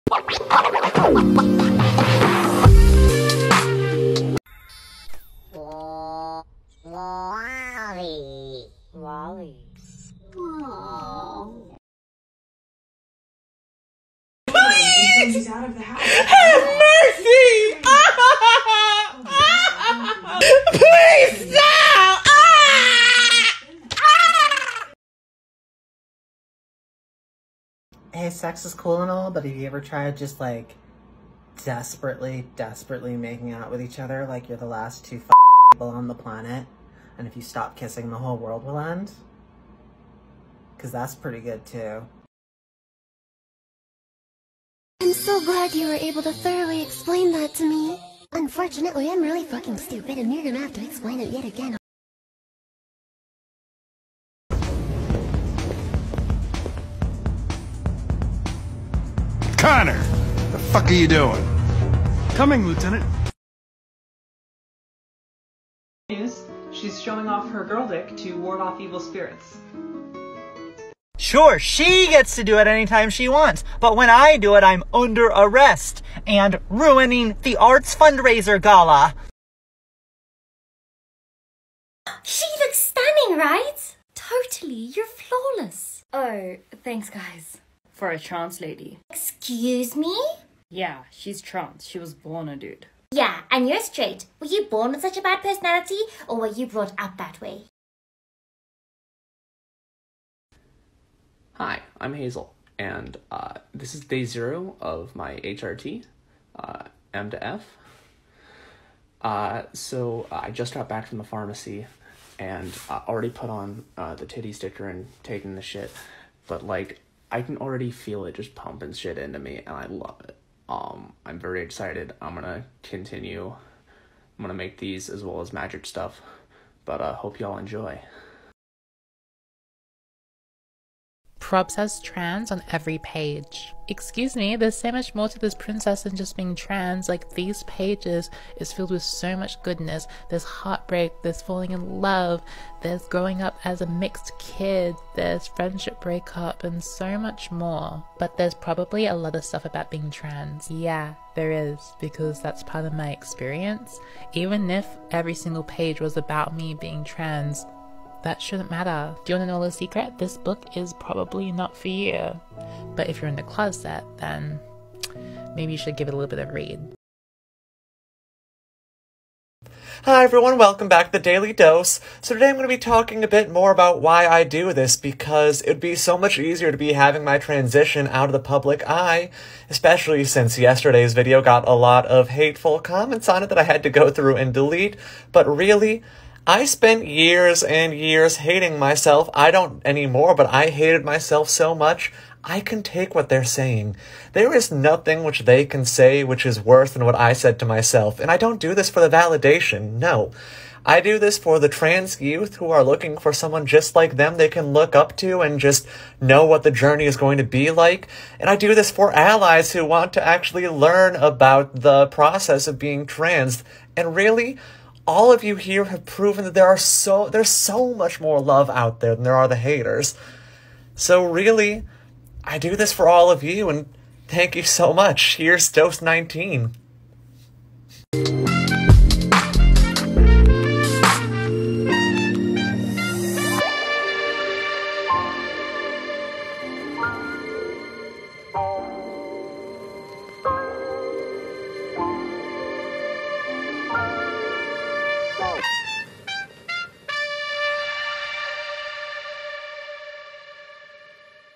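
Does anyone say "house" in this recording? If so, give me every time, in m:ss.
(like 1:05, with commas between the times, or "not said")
0:15.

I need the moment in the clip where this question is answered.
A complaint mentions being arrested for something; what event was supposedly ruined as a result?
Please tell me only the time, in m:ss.
1:17.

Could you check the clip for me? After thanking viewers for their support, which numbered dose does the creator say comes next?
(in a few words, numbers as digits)
19.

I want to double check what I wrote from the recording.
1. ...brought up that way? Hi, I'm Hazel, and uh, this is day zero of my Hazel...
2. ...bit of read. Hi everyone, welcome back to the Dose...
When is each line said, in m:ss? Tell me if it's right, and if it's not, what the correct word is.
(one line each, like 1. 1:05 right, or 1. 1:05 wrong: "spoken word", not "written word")
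1. 1:36 wrong: "HRT", not "Hazel"
2. 2:46 wrong: "Daily", not "Dose".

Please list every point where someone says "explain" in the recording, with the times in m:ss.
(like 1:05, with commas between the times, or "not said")
0:46, 0:50.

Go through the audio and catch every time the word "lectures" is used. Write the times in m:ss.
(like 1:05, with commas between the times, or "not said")
not said.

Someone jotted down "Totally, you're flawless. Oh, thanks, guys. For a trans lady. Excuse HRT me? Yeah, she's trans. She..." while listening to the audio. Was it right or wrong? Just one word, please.
wrong.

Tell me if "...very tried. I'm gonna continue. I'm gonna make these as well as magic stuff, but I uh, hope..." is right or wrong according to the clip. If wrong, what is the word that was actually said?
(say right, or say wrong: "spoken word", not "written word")
wrong: "excited", not "tried".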